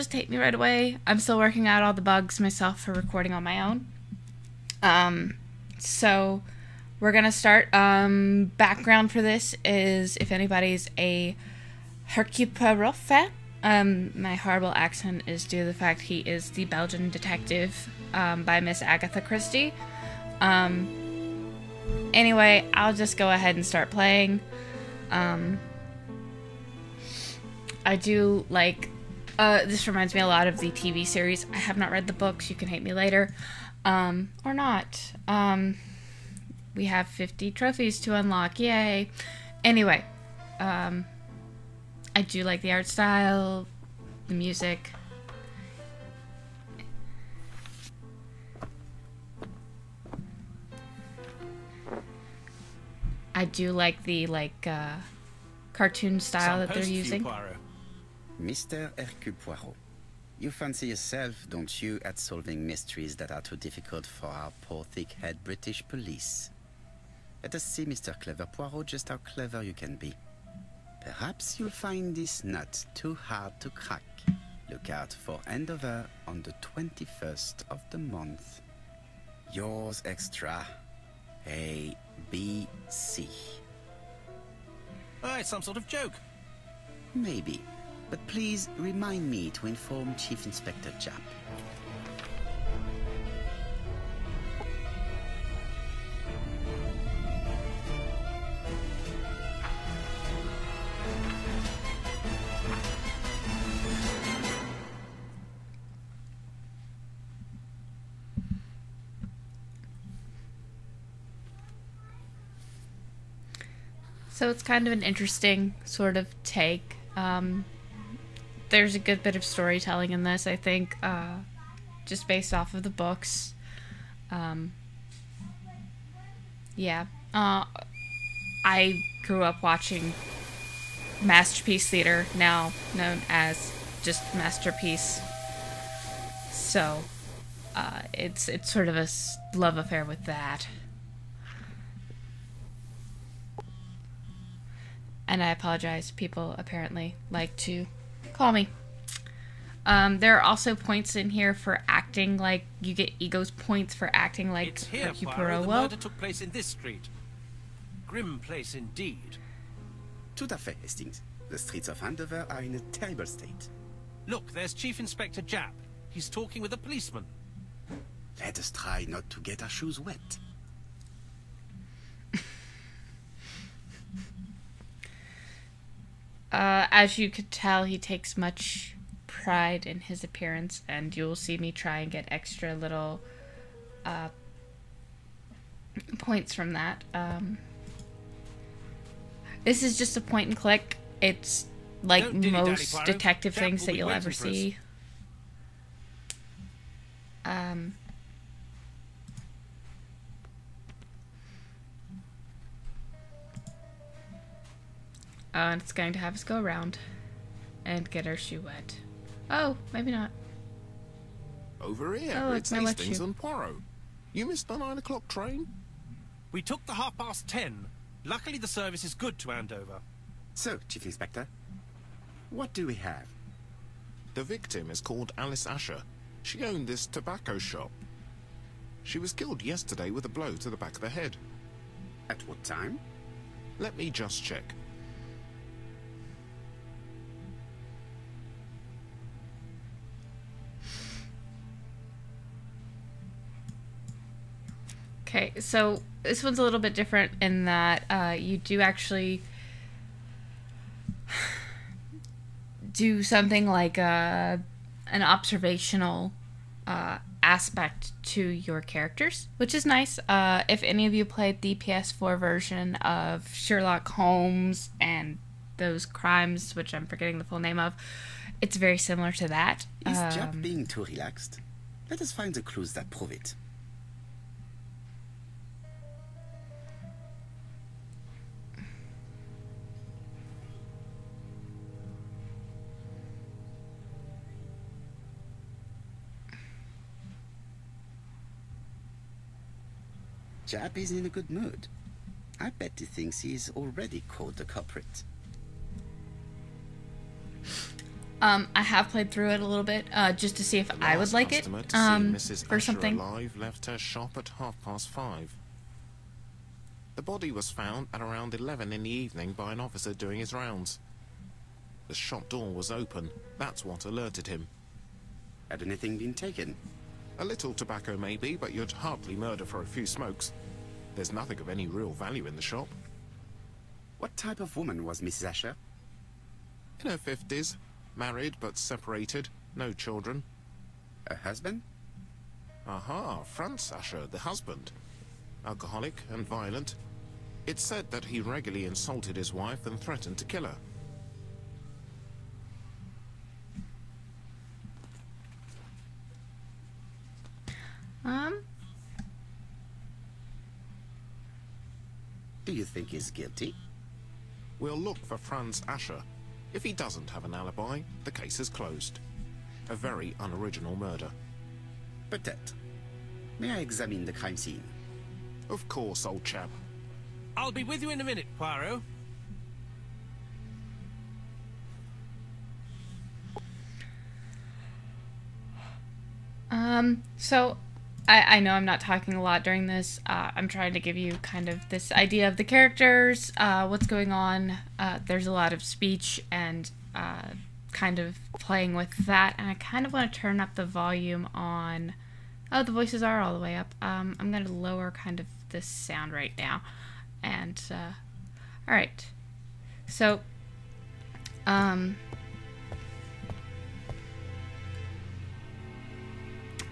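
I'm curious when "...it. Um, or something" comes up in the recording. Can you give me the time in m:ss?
5:01.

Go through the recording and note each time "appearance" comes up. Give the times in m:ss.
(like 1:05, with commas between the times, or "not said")
3:00.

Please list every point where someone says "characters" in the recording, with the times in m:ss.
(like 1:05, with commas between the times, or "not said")
4:18, 6:22.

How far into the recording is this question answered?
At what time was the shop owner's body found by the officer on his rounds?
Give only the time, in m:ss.
5:08.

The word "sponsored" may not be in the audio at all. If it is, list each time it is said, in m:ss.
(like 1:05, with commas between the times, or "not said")
not said.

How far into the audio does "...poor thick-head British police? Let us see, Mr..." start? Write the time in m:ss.
1:04.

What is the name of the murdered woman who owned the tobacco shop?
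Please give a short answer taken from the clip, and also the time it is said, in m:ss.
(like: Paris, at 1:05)
Alice Asher, at 3:45.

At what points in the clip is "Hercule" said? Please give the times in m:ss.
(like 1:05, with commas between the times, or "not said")
0:12, 0:58.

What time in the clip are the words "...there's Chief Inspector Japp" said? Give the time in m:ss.
2:44.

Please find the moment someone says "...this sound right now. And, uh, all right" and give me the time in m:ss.
6:35.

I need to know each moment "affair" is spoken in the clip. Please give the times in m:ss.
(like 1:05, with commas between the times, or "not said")
2:19.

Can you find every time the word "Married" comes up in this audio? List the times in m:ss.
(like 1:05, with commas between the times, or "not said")
5:28.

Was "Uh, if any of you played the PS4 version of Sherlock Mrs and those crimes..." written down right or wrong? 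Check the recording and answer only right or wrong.
wrong.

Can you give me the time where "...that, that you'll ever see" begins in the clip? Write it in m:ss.
3:13.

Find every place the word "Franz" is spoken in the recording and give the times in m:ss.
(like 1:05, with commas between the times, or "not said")
5:33, 5:55.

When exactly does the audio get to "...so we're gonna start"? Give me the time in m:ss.
0:05.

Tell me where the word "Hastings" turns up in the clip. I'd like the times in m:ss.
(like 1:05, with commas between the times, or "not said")
2:40, 3:32.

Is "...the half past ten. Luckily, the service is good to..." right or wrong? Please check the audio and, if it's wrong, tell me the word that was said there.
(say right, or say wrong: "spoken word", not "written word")
right.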